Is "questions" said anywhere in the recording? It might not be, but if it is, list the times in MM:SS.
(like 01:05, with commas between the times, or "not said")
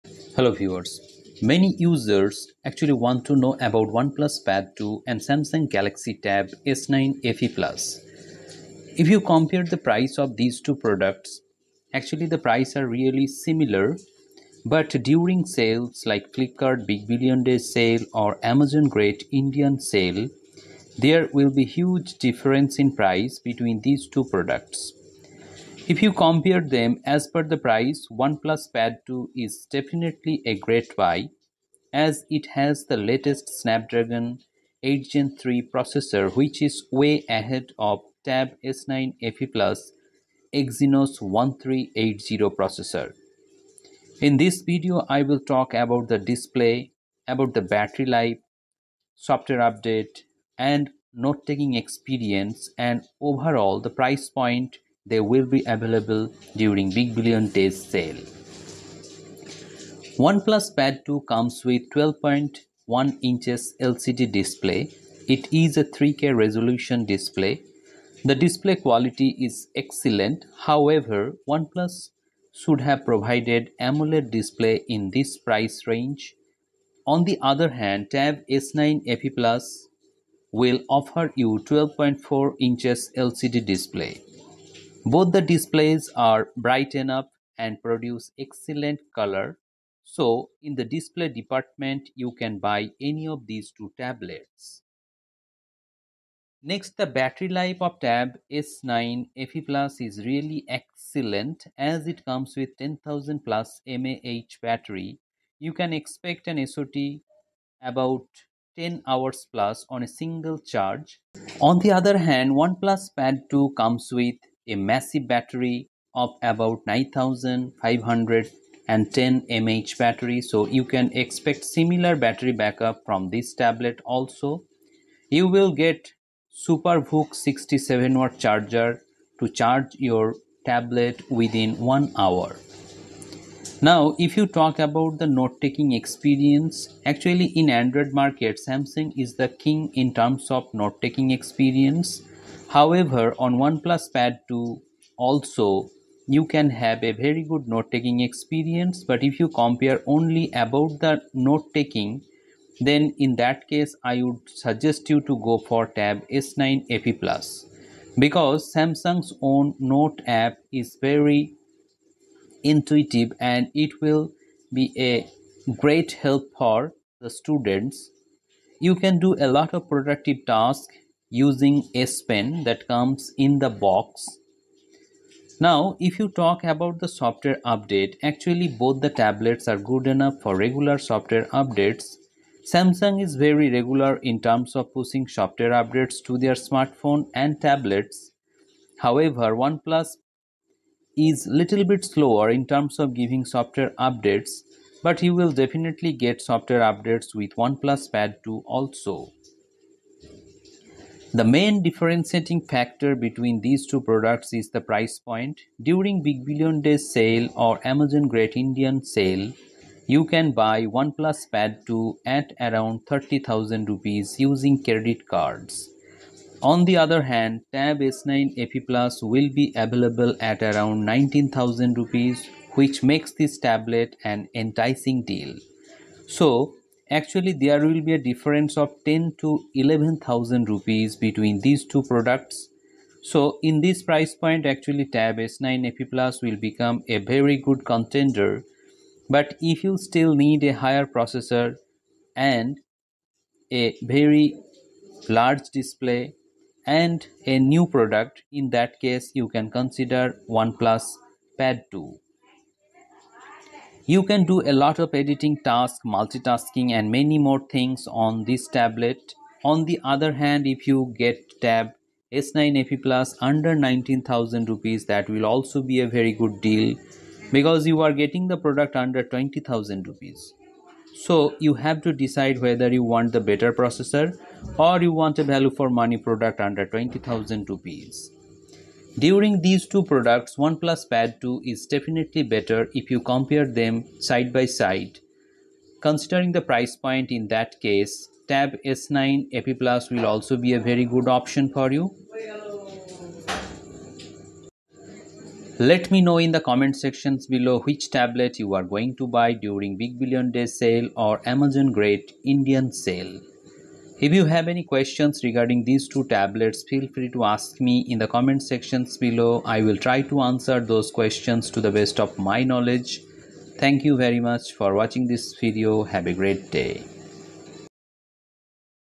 05:04, 05:11.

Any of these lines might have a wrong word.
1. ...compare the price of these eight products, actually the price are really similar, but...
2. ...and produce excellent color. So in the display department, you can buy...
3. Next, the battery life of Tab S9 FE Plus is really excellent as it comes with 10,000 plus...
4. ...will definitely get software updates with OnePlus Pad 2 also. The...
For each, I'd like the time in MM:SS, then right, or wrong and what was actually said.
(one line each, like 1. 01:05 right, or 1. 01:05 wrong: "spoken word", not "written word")
1. 00:09 wrong: "two", not "eight"
2. 01:27 right
3. 01:36 right
4. 03:15 right.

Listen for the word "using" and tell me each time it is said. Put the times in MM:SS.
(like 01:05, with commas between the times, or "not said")
02:51, 03:34.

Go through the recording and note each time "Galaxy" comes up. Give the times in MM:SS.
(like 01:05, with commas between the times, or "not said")
00:05.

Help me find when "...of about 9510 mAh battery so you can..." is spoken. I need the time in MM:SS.
01:56.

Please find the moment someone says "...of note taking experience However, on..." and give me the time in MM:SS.
02:20.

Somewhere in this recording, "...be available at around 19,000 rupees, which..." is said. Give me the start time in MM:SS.
03:39.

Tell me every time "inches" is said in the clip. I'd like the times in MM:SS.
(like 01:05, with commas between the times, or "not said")
01:03, 01:22.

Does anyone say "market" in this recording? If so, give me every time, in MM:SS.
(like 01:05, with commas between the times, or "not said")
02:18.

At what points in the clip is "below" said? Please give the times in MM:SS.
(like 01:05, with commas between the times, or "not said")
04:57, 05:09.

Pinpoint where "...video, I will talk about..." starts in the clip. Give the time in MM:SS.
00:44.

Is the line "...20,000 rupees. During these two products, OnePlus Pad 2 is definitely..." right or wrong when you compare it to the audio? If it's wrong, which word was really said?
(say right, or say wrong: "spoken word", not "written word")
right.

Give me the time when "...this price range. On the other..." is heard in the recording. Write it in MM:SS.
01:15.